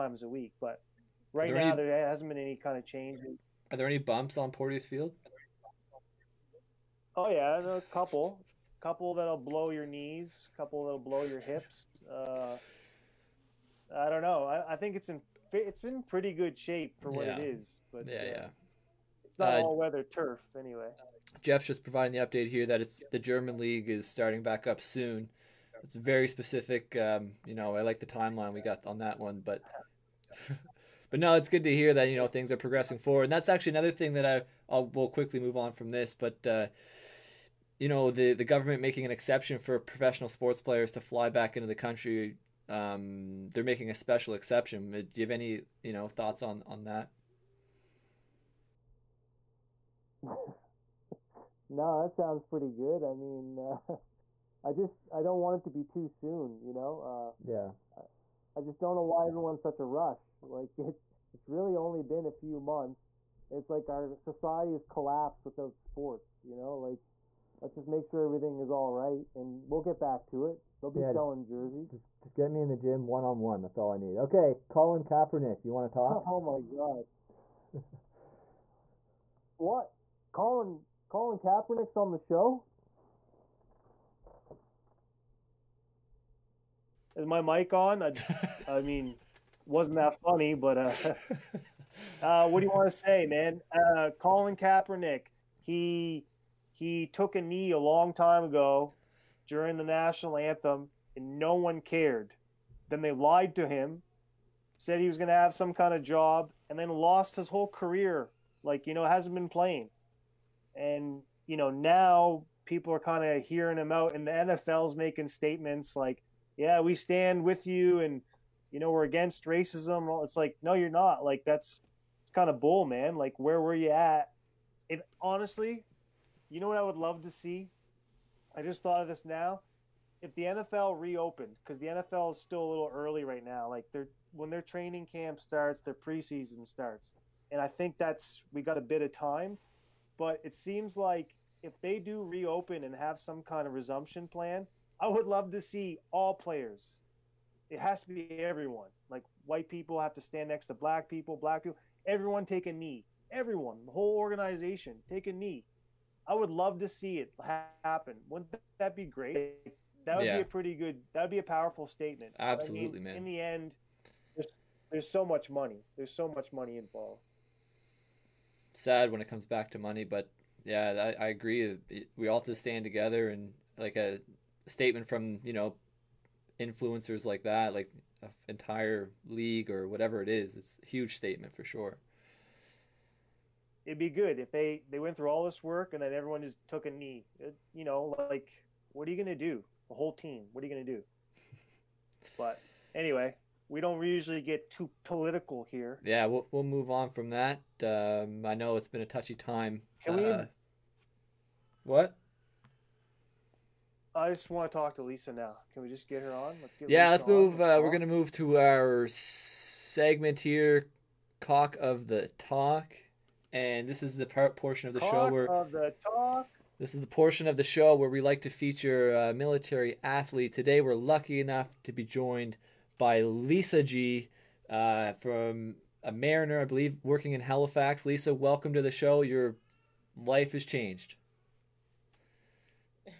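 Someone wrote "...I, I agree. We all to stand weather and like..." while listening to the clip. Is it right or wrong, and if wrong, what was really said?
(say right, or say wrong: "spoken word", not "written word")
wrong: "together", not "weather".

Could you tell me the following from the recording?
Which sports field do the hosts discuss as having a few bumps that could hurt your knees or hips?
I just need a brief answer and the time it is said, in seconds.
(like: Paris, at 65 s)
Porteous Field, at 4 s.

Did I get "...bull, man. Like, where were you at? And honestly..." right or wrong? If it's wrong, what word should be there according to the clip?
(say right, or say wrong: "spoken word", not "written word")
right.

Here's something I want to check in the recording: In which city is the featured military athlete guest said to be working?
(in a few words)
Halifax.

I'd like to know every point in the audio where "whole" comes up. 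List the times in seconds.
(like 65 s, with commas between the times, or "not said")
107 s, 153 s, 189 s.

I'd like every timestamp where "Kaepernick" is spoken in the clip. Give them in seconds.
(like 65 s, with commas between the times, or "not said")
75 s, 81 s, 94 s.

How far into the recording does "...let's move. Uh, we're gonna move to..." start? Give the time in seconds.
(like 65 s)
207 s.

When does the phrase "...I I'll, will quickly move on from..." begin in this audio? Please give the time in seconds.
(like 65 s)
34 s.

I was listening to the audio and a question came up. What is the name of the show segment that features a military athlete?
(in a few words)
Cock of the Talk.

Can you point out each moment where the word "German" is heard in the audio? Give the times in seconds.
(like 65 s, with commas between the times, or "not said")
23 s.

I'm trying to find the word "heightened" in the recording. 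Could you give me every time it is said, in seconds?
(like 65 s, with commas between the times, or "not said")
not said.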